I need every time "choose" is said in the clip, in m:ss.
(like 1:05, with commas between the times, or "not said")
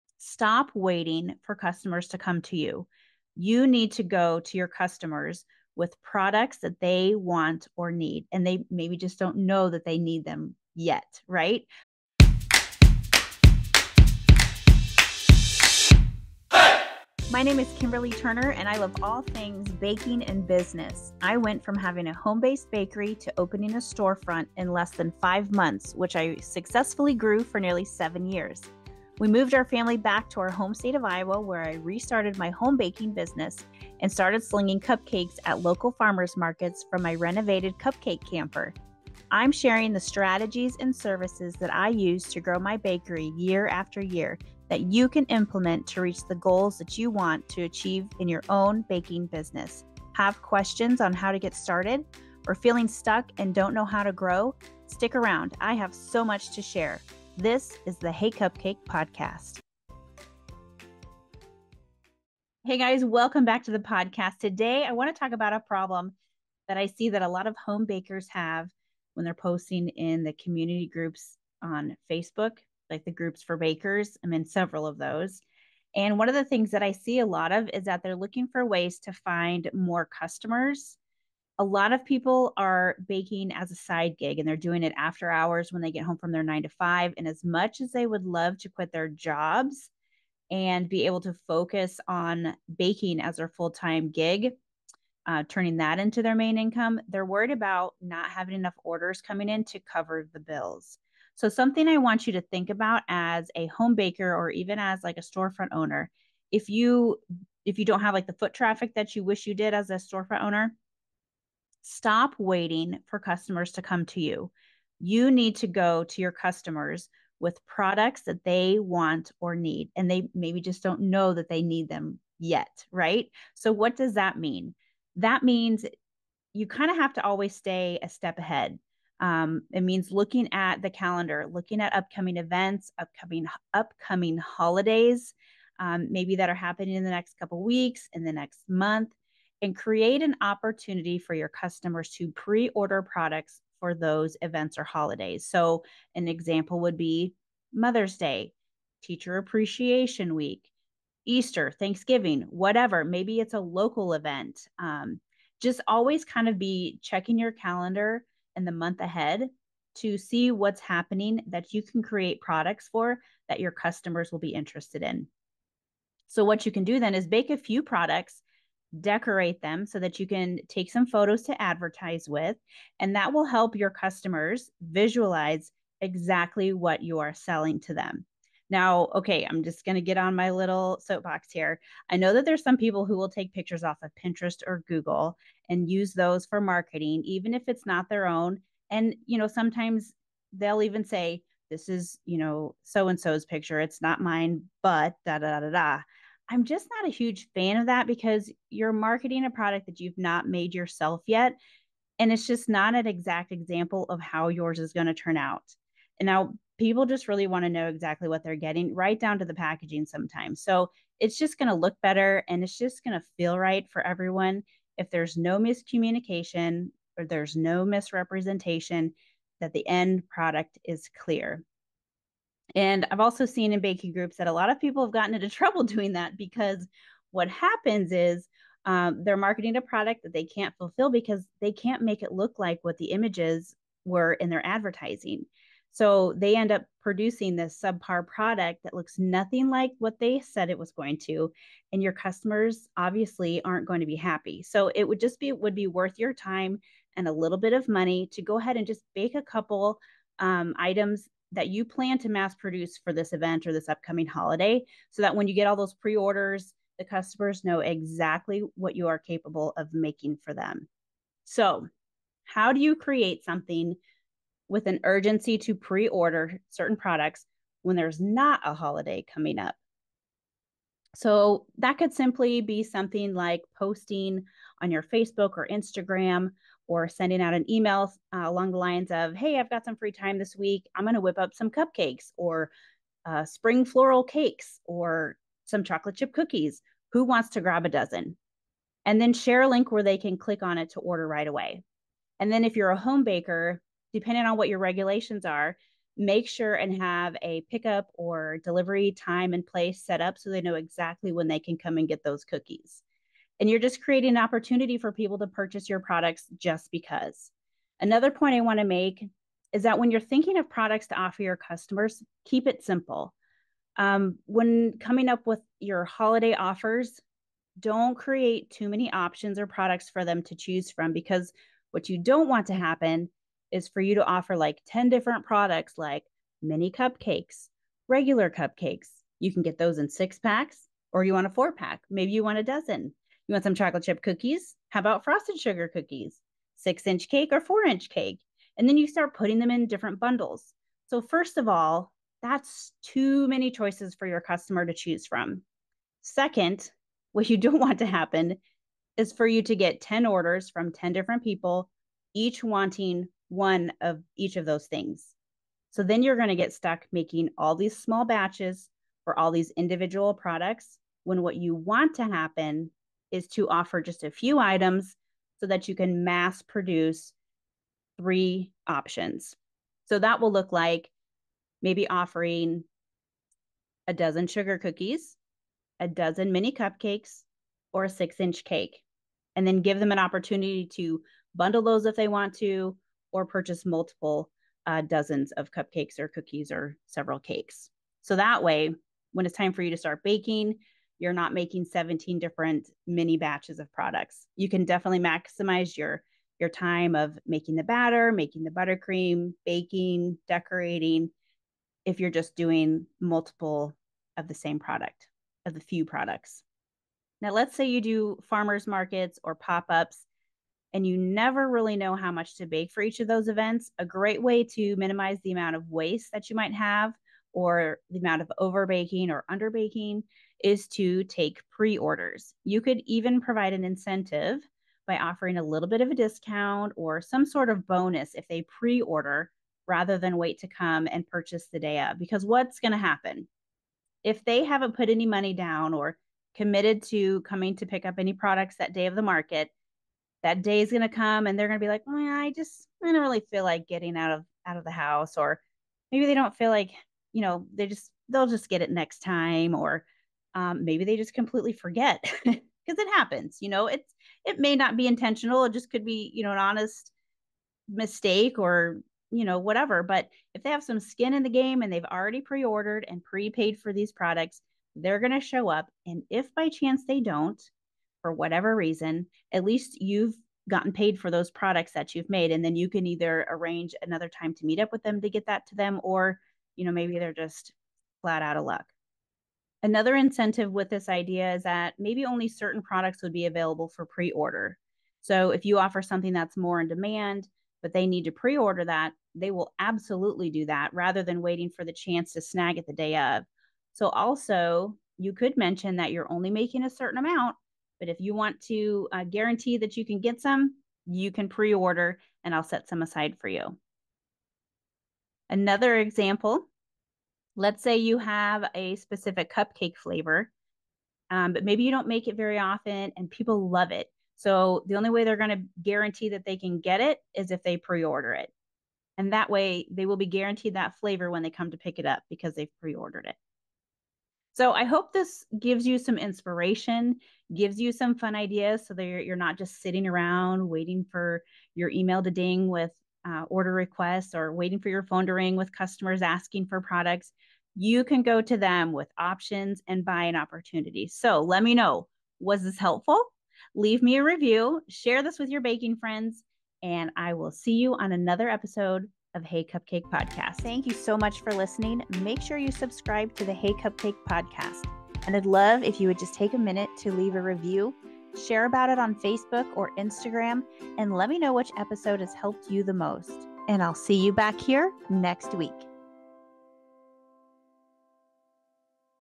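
5:20, 5:44.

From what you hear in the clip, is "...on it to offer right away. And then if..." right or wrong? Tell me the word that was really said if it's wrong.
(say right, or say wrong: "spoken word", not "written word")
wrong: "order", not "offer".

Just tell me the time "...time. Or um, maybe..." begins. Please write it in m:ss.
7:29.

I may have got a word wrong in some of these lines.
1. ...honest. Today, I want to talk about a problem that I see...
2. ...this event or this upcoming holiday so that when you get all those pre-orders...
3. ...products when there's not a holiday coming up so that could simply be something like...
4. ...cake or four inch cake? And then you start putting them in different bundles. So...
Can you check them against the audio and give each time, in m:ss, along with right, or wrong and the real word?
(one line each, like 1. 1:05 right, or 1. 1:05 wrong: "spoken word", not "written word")
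1. 1:03 wrong: "podcast", not "honest"
2. 4:13 right
3. 4:26 right
4. 5:37 right.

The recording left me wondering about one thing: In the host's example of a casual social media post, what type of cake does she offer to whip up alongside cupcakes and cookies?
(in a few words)
spring floral cakes.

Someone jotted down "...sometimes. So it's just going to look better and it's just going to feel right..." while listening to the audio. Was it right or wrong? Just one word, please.
right.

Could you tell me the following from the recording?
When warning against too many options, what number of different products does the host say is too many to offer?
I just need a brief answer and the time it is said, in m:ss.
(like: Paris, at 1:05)
10, at 5:24.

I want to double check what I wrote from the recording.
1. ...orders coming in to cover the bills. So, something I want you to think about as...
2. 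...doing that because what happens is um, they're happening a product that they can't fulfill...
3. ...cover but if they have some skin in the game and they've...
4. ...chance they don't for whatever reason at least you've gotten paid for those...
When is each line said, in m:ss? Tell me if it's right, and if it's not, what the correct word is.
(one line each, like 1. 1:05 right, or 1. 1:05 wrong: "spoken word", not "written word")
1. 1:38 right
2. 3:45 wrong: "marketing", not "happening"
3. 7:39 wrong: "whatever", not "cover"
4. 7:46 right.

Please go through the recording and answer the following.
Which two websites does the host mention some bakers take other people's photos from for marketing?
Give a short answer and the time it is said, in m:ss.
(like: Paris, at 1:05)
Pinterest or Google, at 3:04.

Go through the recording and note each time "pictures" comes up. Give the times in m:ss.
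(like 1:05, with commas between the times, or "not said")
3:03, 3:13.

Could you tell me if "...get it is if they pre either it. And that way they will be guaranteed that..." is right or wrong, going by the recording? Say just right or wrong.
wrong.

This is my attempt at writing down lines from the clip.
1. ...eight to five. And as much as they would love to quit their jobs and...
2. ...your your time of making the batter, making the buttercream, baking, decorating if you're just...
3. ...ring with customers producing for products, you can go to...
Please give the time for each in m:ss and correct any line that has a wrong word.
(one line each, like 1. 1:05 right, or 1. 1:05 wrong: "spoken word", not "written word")
1. 1:26 wrong: "nine", not "eight"
2. 6:35 right
3. 8:55 wrong: "asking", not "producing".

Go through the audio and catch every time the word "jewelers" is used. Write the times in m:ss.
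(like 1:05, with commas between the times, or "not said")
not said.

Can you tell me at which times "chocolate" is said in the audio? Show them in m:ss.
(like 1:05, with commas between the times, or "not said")
4:45, 5:33.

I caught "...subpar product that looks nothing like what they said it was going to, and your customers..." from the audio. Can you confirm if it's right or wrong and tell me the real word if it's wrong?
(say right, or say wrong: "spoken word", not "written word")
right.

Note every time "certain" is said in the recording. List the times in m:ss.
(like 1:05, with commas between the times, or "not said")
4:26, 8:02, 8:16.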